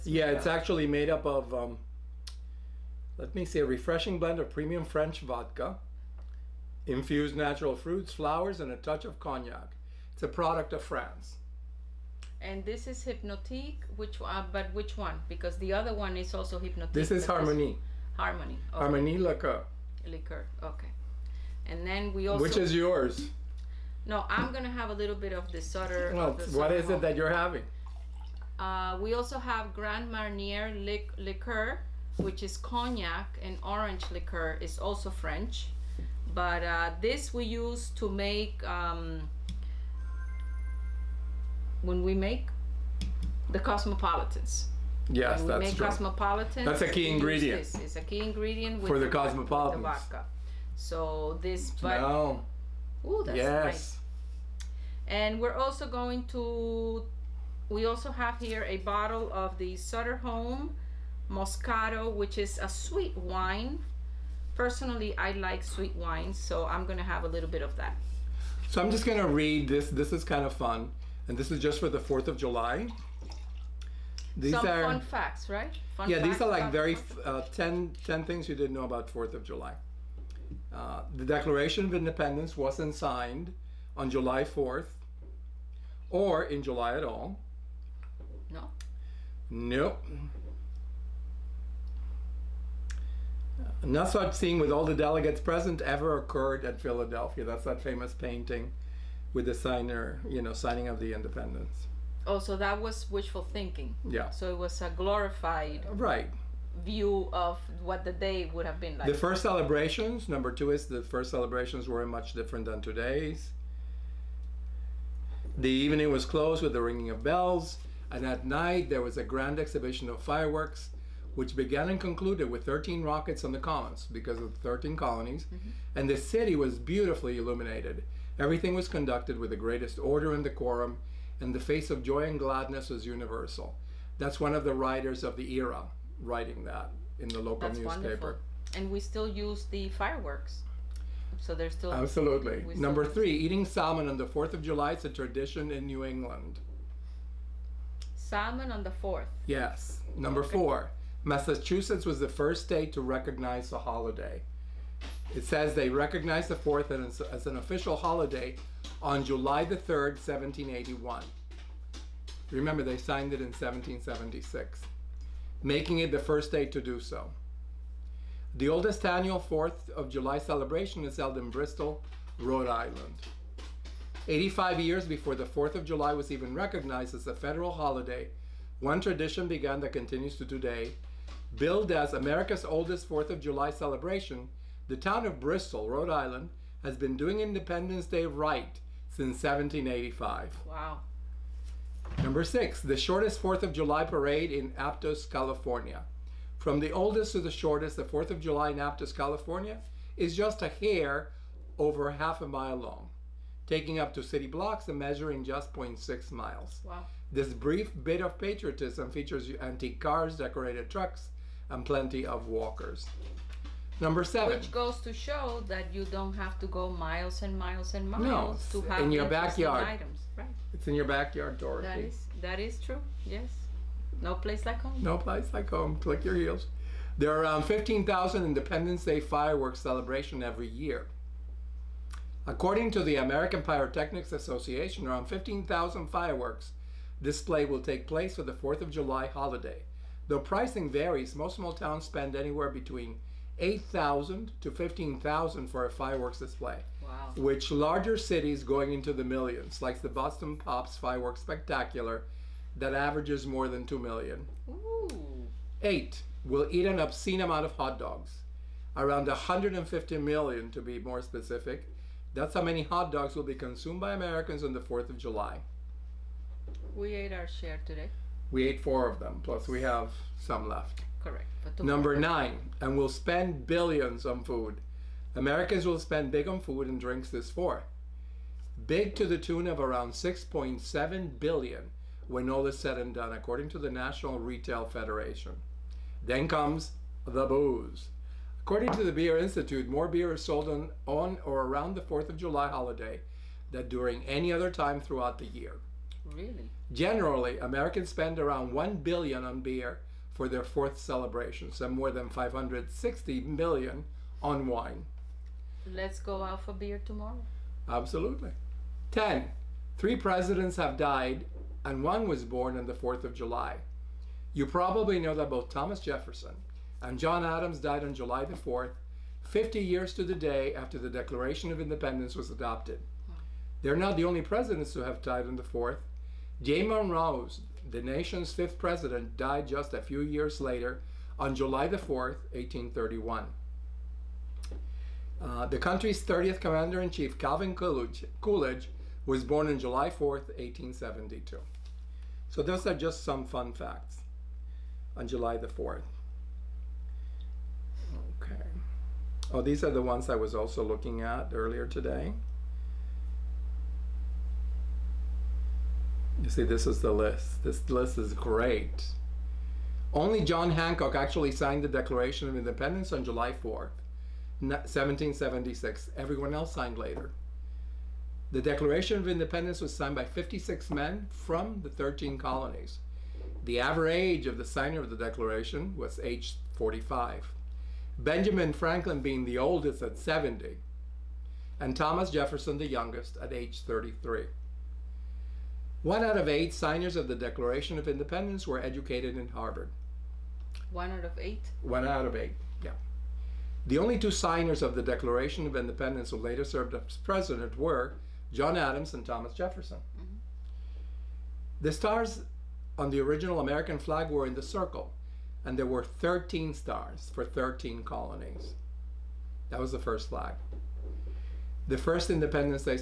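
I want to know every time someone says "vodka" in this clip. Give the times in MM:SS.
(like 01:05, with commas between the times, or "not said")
00:05, 00:49.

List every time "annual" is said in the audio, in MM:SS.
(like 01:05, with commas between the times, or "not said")
02:49.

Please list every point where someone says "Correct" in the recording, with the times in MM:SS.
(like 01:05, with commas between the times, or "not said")
04:31.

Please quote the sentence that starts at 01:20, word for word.
Uh, the Declaration of Independence wasn't signed on July 4th or in July at all.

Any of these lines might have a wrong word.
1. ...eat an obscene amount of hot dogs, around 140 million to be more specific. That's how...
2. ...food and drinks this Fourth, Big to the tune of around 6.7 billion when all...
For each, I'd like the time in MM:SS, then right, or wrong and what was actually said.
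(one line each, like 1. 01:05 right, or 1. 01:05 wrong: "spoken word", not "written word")
1. 04:16 wrong: "150", not "140"
2. 04:36 right.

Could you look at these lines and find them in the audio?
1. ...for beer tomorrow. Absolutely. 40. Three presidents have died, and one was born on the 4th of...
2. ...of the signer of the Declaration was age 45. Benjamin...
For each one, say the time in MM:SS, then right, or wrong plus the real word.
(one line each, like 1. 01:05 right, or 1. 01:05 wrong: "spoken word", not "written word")
1. 05:06 wrong: "10", not "40"
2. 06:14 right.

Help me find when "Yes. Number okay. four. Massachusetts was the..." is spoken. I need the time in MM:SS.
02:29.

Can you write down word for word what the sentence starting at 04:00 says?
Though pricing varies, most small towns spend anywhere between 8,000 to 15,000 for a fireworks display wow.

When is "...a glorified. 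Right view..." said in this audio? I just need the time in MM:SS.
01:44.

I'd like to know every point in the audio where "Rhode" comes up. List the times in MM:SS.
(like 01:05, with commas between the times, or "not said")
02:52, 03:05.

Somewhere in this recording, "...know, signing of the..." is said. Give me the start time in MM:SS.
01:40.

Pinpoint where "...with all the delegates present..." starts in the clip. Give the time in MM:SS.
01:34.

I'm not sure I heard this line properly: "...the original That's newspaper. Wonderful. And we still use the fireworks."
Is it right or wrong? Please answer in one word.
wrong.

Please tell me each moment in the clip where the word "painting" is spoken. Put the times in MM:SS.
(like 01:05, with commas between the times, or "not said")
01:38.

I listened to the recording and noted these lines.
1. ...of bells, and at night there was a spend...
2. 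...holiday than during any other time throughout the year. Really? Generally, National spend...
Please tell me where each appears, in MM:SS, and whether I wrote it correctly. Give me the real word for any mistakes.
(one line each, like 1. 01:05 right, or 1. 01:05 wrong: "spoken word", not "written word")
1. 01:57 wrong: "grand", not "spend"
2. 04:52 wrong: "Americans", not "National".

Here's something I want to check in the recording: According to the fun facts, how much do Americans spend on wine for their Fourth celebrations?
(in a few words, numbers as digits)
560 million.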